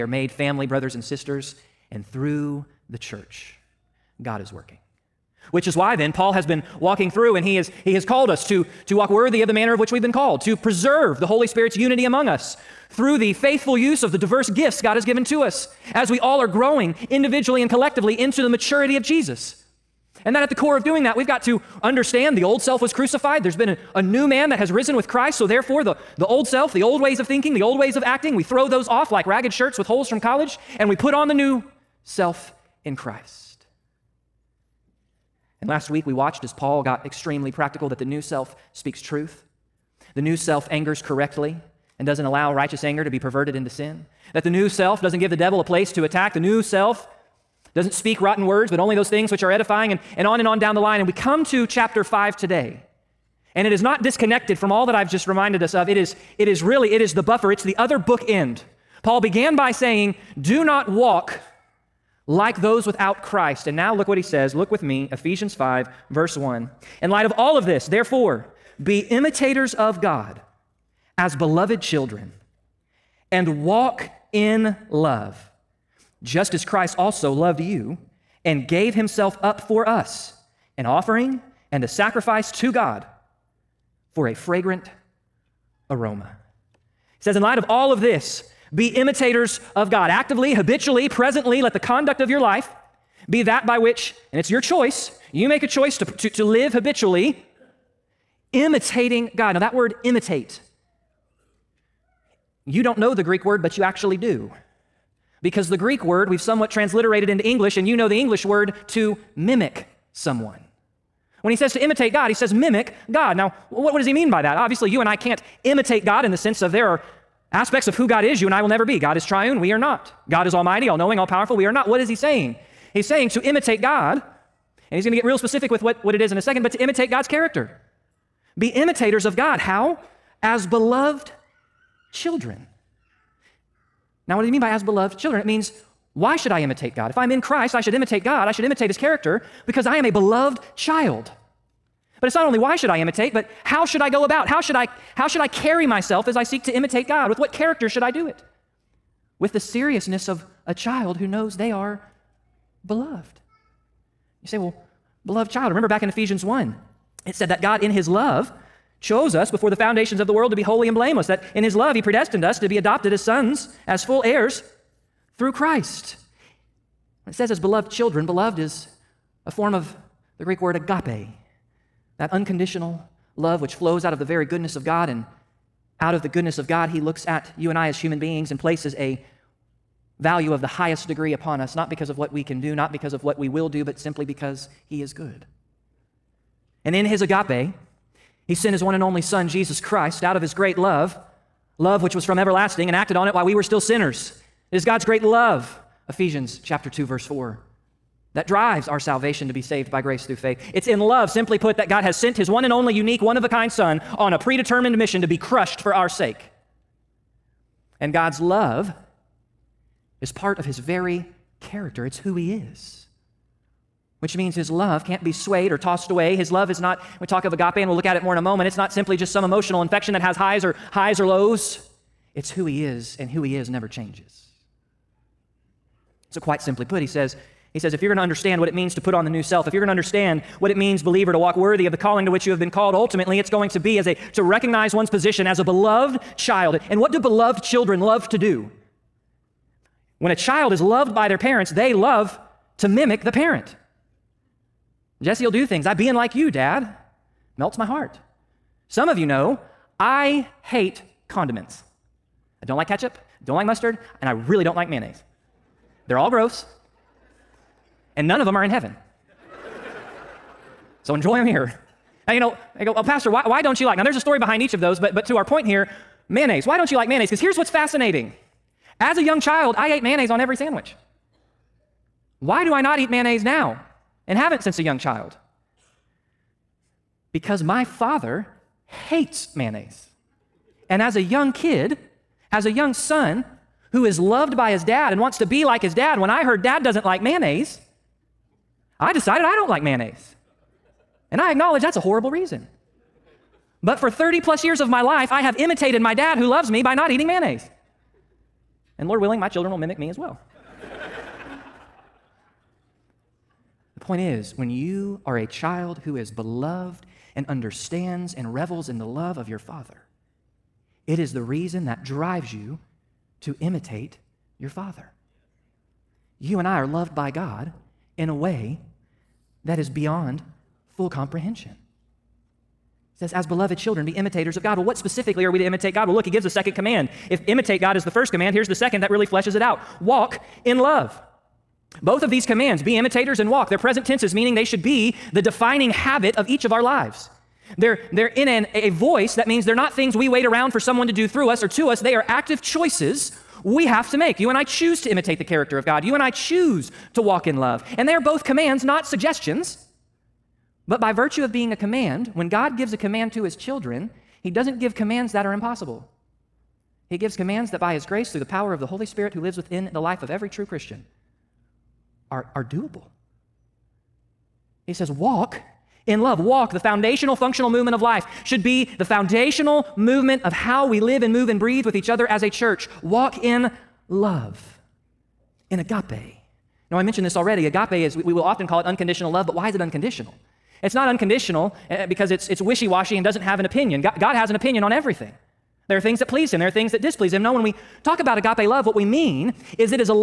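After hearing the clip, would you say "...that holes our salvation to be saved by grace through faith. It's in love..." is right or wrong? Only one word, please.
wrong.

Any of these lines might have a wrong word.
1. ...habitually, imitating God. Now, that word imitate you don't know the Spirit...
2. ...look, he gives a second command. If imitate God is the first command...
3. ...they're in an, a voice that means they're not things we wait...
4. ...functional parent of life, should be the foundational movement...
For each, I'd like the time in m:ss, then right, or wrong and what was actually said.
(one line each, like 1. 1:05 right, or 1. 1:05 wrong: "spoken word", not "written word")
1. 1:36 wrong: "Greek", not "Spirit"
2. 5:26 right
3. 5:38 right
4. 6:07 wrong: "movement", not "parent".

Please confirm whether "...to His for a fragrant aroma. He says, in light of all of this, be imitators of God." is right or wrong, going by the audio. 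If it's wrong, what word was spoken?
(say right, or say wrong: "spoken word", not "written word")
wrong: "God", not "His".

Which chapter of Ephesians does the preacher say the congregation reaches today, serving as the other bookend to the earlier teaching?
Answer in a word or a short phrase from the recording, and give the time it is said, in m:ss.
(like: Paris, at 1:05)
Chapter 5, at 0:51.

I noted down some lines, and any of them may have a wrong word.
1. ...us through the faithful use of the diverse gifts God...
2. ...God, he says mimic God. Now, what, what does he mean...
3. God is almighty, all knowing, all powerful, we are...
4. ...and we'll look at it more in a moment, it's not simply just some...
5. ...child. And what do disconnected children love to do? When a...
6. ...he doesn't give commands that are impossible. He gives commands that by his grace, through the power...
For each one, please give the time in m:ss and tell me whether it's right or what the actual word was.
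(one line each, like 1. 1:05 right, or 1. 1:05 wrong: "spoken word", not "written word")
1. 0:12 right
2. 1:52 right
3. 2:00 right
4. 3:37 right
5. 3:56 wrong: "beloved", not "disconnected"
6. 5:54 right.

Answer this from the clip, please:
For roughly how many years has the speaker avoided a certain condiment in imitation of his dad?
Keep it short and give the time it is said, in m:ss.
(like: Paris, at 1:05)
30 plus years, at 4:54.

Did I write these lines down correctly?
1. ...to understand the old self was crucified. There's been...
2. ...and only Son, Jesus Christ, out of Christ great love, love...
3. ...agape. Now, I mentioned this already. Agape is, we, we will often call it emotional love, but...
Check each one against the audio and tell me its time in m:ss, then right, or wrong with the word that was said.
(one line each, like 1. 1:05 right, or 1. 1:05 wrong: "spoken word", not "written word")
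1. 0:21 right
2. 3:08 wrong: "His", not "Christ"
3. 6:15 wrong: "unconditional", not "emotional".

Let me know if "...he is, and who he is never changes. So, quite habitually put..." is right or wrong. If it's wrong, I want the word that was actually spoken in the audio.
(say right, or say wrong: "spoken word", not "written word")
wrong: "simply", not "habitually".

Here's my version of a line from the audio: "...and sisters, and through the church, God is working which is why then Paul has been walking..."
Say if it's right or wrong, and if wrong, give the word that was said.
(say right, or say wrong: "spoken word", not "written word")
right.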